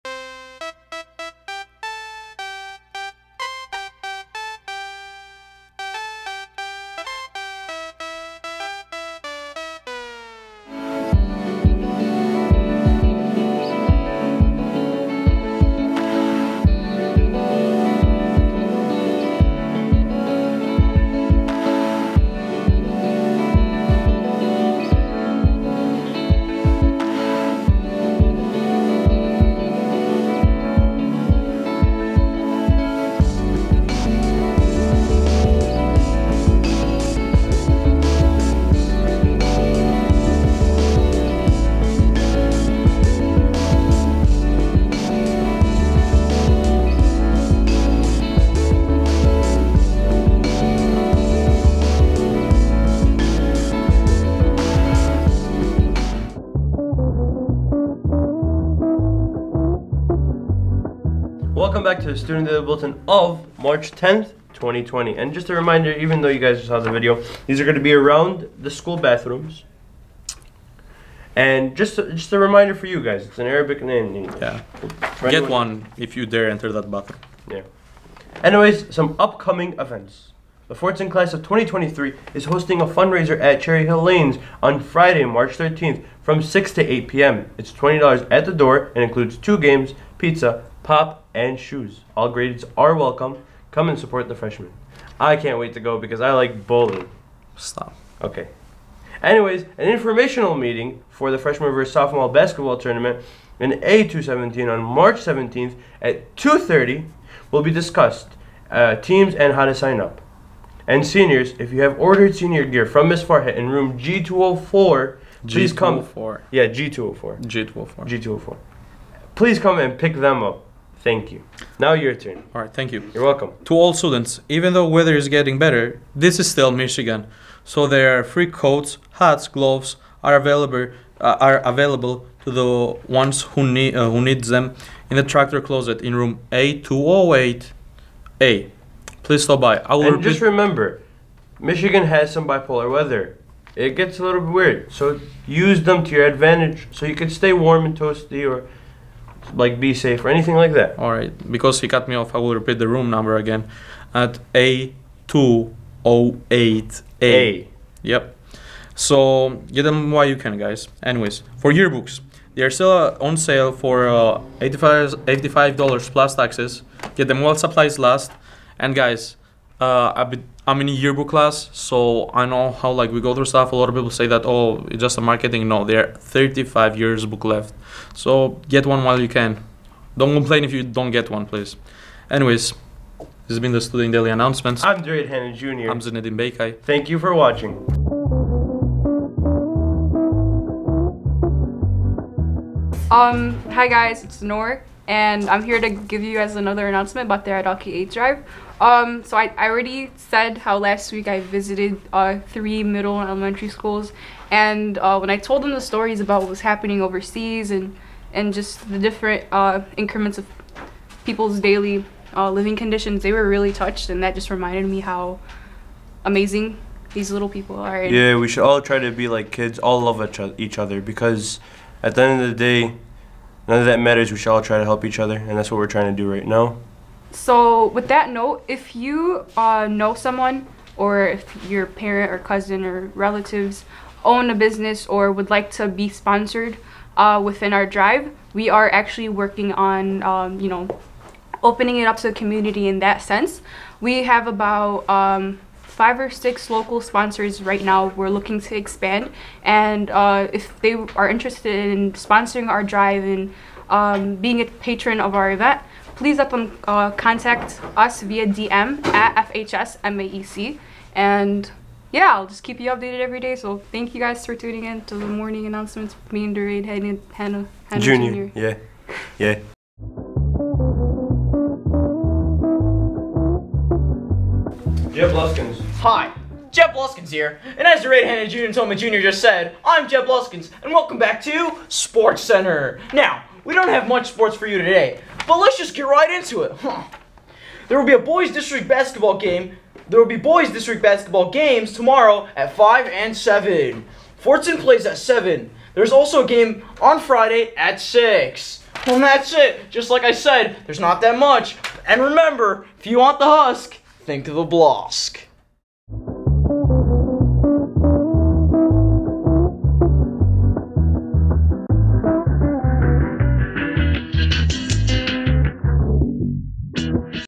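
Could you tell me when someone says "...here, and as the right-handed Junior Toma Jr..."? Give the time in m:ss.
4:37.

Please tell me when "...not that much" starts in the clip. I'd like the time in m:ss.
5:01.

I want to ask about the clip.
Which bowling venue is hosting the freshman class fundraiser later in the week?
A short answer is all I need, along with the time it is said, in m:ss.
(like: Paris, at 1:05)
Cherry Hill Lanes, at 1:23.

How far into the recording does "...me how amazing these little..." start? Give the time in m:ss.
3:34.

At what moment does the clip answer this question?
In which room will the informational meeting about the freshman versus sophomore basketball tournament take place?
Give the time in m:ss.
1:43.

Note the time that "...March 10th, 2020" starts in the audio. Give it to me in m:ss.
1:03.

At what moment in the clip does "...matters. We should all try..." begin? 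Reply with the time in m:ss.
3:44.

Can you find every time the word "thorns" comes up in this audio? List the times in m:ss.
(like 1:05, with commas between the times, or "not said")
not said.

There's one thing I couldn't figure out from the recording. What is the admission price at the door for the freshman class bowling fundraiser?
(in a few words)
$20.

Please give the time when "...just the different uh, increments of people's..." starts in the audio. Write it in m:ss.
3:28.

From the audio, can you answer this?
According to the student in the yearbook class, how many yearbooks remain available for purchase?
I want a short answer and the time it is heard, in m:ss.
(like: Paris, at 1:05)
35, at 2:56.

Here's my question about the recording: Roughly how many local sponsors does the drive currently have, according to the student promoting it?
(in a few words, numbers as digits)
5 or 6.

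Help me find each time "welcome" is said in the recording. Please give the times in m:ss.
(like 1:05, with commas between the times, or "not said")
1:01, 1:32, 2:03, 4:40.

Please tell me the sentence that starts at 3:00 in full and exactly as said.
Don't complain if you don't get one, please.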